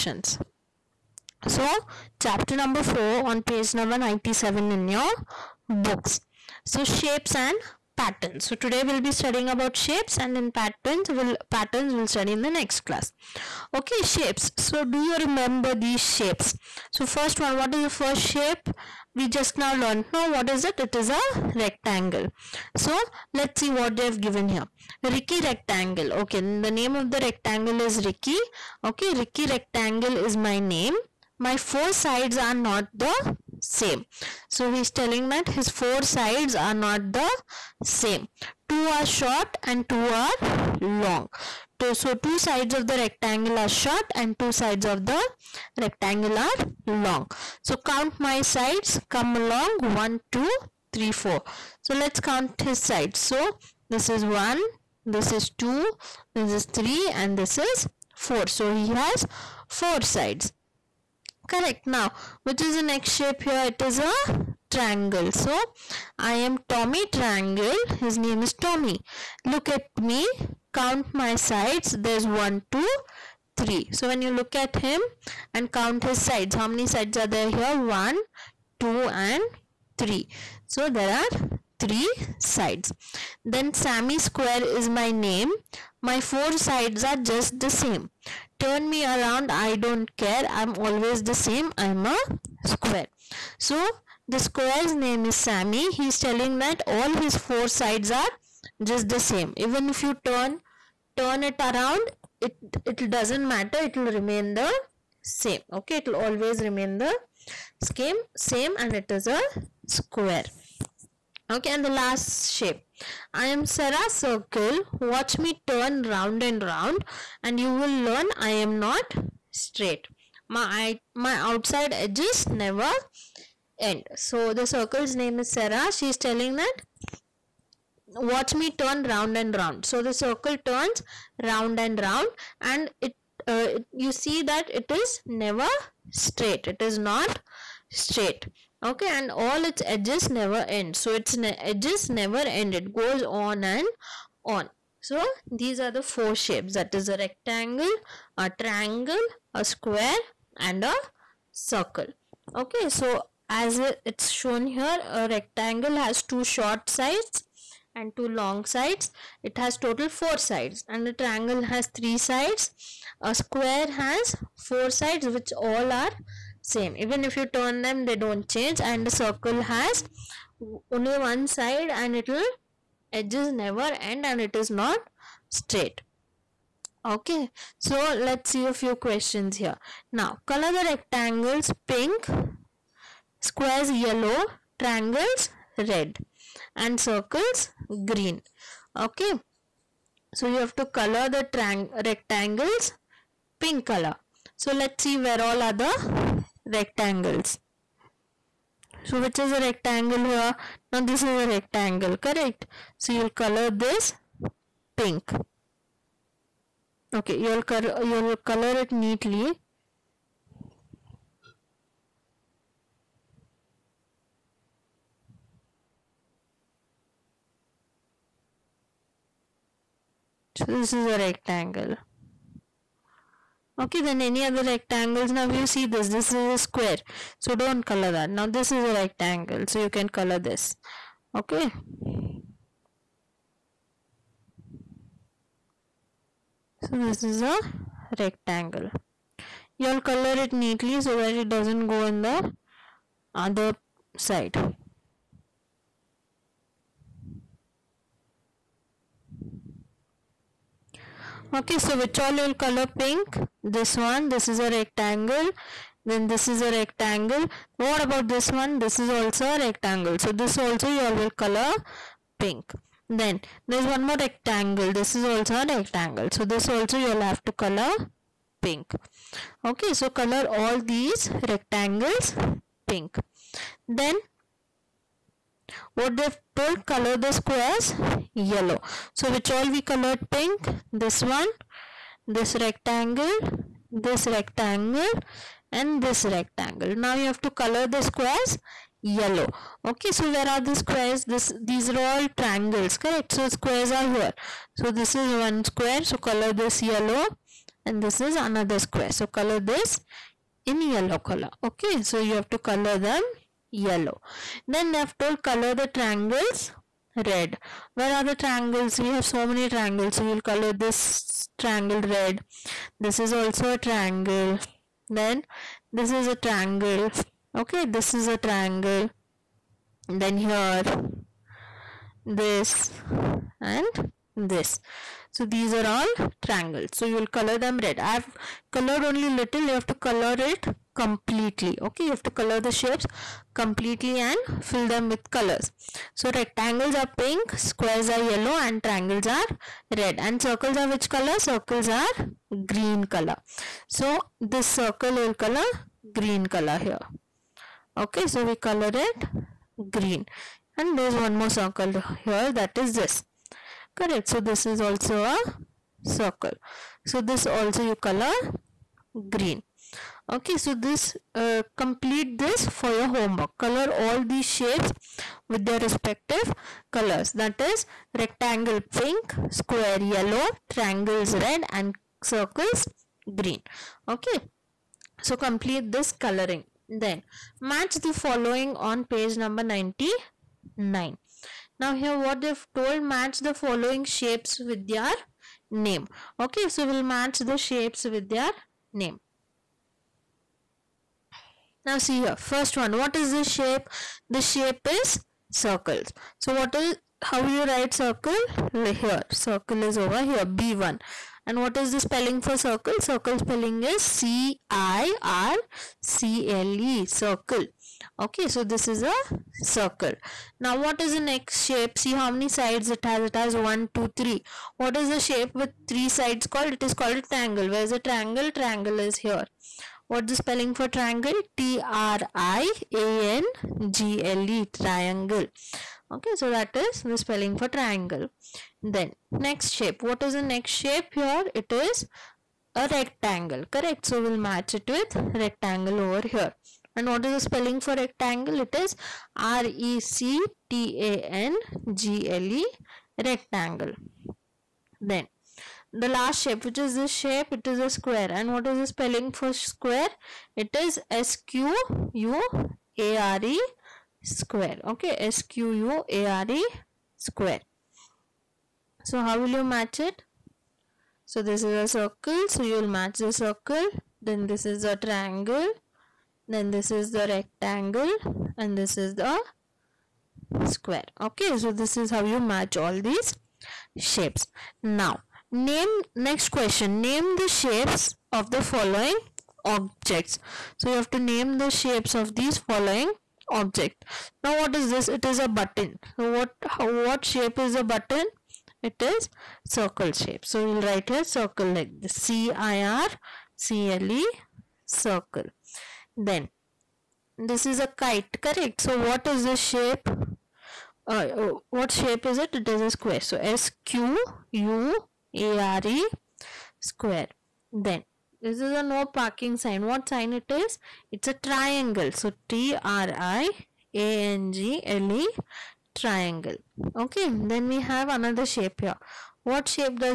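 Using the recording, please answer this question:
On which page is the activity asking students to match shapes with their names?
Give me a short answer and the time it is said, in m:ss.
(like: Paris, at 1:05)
99, at 6:19.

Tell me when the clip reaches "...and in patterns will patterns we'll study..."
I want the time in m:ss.
0:10.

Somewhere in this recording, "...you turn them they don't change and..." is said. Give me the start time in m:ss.
2:47.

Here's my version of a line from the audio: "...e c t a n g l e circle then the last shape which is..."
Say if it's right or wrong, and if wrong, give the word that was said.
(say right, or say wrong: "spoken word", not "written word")
wrong: "rectangle", not "circle".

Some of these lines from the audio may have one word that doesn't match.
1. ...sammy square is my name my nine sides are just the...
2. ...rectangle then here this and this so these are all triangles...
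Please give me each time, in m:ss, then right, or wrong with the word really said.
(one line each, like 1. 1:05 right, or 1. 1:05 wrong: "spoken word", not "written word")
1. 1:23 wrong: "four", not "nine"
2. 5:18 wrong: "triangle", not "rectangle".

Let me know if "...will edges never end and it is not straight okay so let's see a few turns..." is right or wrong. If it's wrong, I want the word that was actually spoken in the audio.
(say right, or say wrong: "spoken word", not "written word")
wrong: "questions", not "turns".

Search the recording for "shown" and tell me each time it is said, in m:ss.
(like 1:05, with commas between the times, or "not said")
2:34.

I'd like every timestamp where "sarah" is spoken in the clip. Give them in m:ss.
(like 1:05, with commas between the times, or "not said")
1:53, 2:05.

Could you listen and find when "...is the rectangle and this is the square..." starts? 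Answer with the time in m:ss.
7:46.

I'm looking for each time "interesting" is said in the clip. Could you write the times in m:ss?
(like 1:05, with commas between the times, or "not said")
not said.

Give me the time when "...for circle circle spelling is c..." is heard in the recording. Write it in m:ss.
6:42.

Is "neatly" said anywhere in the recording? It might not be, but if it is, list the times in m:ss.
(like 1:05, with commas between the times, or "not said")
3:28, 4:00.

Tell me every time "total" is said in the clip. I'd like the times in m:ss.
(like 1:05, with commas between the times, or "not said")
2:39.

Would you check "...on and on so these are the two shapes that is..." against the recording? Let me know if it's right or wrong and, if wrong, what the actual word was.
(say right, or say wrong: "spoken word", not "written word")
wrong: "four", not "two".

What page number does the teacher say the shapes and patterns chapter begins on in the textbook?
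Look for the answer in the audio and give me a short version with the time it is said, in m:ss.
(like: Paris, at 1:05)
97, at 0:03.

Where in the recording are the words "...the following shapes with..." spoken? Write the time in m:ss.
6:23.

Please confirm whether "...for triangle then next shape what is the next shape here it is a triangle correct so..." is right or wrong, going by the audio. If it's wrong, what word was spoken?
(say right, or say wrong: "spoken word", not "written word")
wrong: "rectangle", not "triangle".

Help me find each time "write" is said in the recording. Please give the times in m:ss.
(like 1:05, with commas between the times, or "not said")
6:37, 8:10.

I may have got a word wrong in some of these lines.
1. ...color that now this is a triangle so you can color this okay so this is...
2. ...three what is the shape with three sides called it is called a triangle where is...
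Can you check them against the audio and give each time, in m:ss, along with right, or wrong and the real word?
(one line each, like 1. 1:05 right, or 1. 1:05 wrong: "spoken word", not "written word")
1. 3:47 wrong: "rectangle", not "triangle"
2. 6:54 right.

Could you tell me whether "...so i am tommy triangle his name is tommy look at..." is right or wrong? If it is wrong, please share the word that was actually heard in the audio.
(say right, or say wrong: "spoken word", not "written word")
right.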